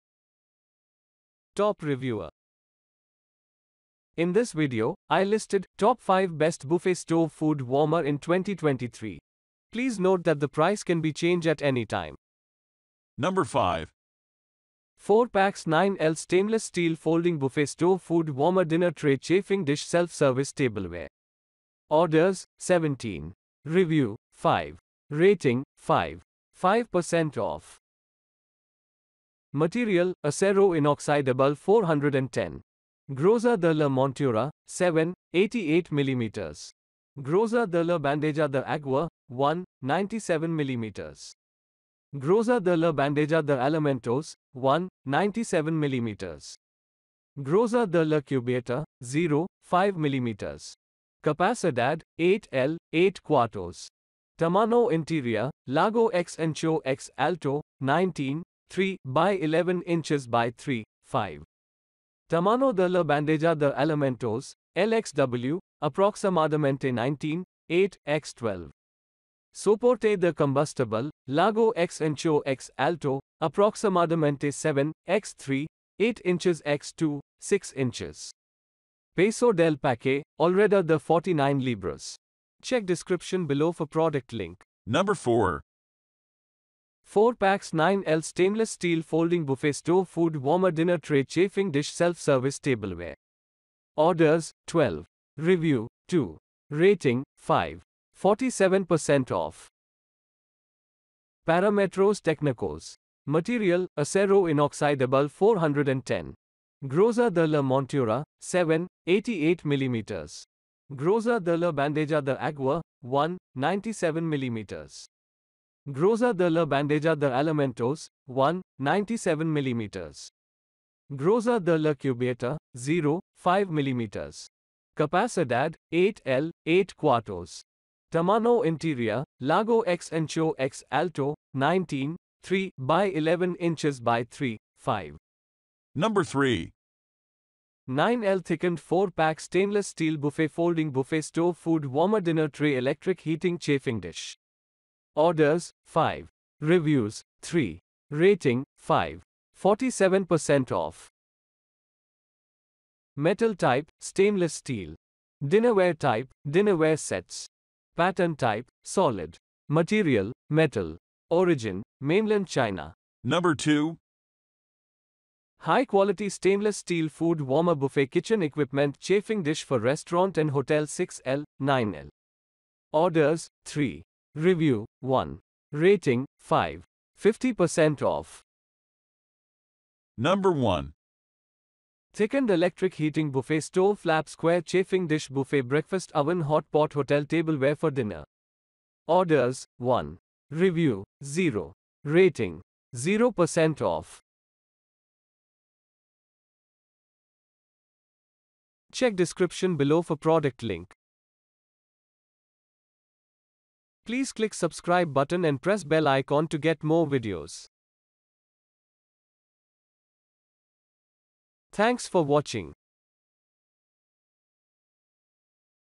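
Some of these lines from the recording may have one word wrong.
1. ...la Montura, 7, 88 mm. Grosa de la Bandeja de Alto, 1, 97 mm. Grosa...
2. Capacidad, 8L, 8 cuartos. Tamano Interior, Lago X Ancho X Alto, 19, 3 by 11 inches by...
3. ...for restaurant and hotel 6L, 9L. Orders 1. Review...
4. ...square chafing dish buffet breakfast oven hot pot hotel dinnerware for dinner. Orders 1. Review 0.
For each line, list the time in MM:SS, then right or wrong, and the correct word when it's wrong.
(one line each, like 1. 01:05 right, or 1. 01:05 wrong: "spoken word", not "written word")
1. 00:33 wrong: "Agua", not "Alto"
2. 00:51 right
3. 02:49 wrong: "3", not "1"
4. 03:04 wrong: "tableware", not "dinnerware".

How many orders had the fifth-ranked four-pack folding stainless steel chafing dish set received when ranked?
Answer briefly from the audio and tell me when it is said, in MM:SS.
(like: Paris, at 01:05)
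17, at 00:21.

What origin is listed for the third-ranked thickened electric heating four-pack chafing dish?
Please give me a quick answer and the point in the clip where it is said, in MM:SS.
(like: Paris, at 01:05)
Mainland China, at 02:41.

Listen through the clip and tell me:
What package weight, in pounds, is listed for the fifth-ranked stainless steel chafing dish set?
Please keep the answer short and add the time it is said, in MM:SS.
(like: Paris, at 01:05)
49 pounds, at 01:20.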